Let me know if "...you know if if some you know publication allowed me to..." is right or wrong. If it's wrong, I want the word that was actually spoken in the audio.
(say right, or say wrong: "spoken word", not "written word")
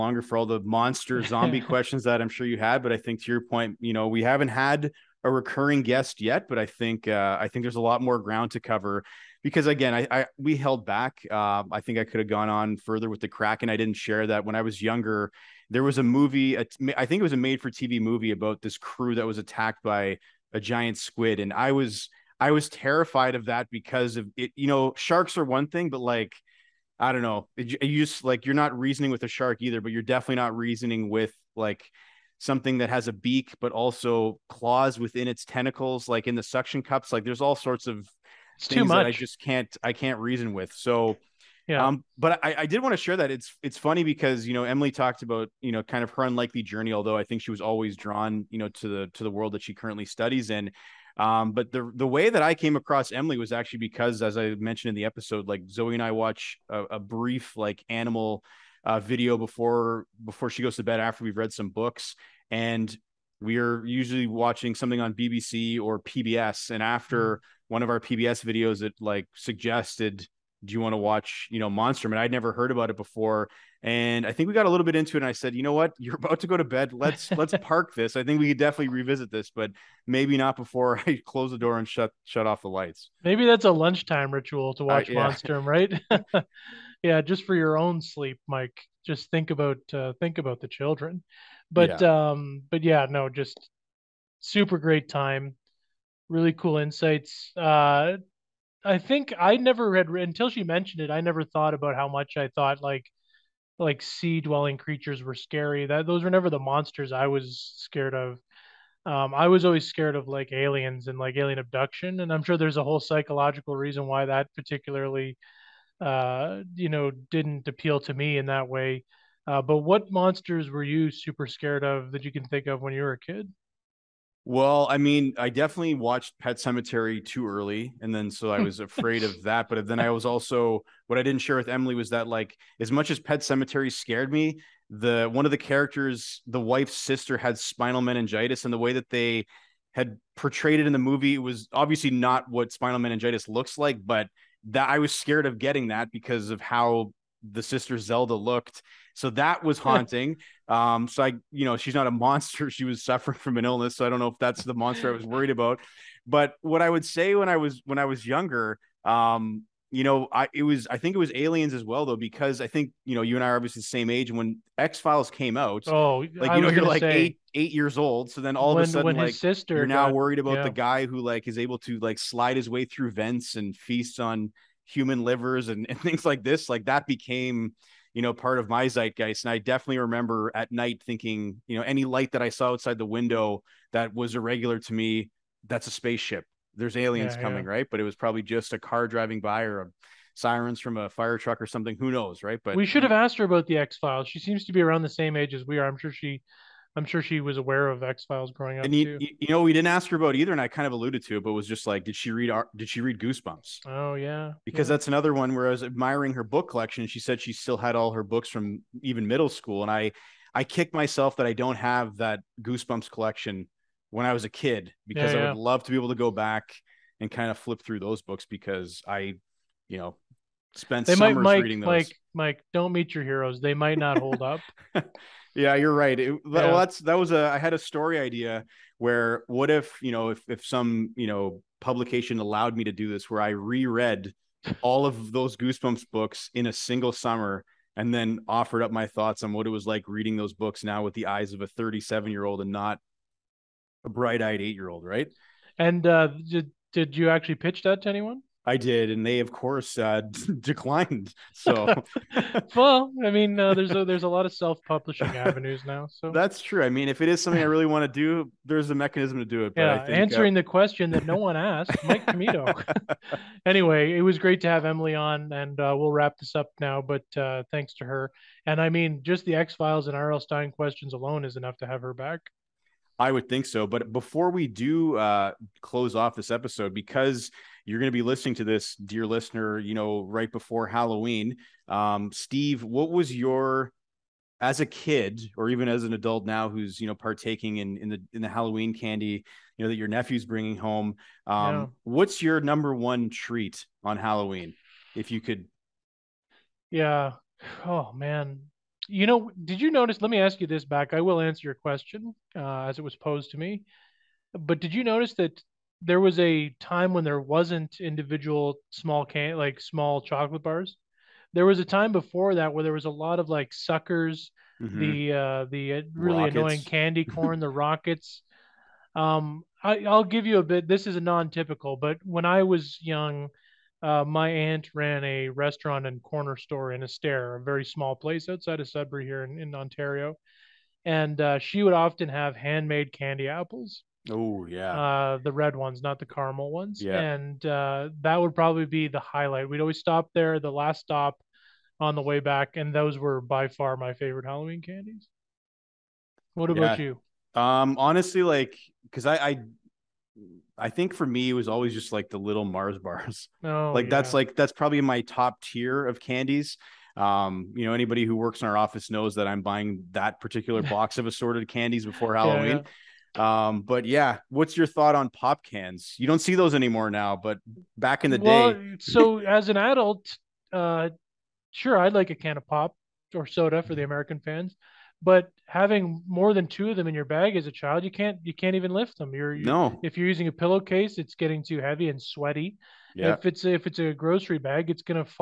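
right.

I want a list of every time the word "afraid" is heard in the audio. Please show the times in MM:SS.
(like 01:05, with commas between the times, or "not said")
02:08.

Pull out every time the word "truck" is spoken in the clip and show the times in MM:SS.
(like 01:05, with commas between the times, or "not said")
03:11.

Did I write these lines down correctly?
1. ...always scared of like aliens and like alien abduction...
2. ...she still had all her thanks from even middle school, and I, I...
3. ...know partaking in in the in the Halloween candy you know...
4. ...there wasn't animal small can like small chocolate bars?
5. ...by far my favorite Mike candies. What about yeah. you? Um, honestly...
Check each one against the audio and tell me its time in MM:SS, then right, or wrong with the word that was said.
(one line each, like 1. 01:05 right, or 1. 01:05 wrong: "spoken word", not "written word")
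1. 01:49 right
2. 03:27 wrong: "books", not "thanks"
3. 04:47 right
4. 05:07 wrong: "individual", not "animal"
5. 05:43 wrong: "Halloween", not "Mike".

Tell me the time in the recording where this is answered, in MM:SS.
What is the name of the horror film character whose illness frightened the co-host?
02:27.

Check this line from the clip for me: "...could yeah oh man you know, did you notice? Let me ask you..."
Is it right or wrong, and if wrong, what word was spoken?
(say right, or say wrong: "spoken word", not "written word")
right.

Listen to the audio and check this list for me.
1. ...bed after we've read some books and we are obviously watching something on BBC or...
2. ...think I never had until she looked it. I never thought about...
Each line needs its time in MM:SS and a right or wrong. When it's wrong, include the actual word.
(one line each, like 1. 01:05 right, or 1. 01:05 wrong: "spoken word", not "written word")
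1. 01:00 wrong: "usually", not "obviously"
2. 01:38 wrong: "mentioned", not "looked".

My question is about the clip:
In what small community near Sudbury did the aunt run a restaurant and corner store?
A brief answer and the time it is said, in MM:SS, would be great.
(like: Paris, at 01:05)
Estaire, at 05:27.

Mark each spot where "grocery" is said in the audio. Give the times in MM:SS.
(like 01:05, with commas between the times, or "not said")
06:24.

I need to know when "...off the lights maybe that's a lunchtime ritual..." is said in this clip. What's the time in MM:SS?
01:22.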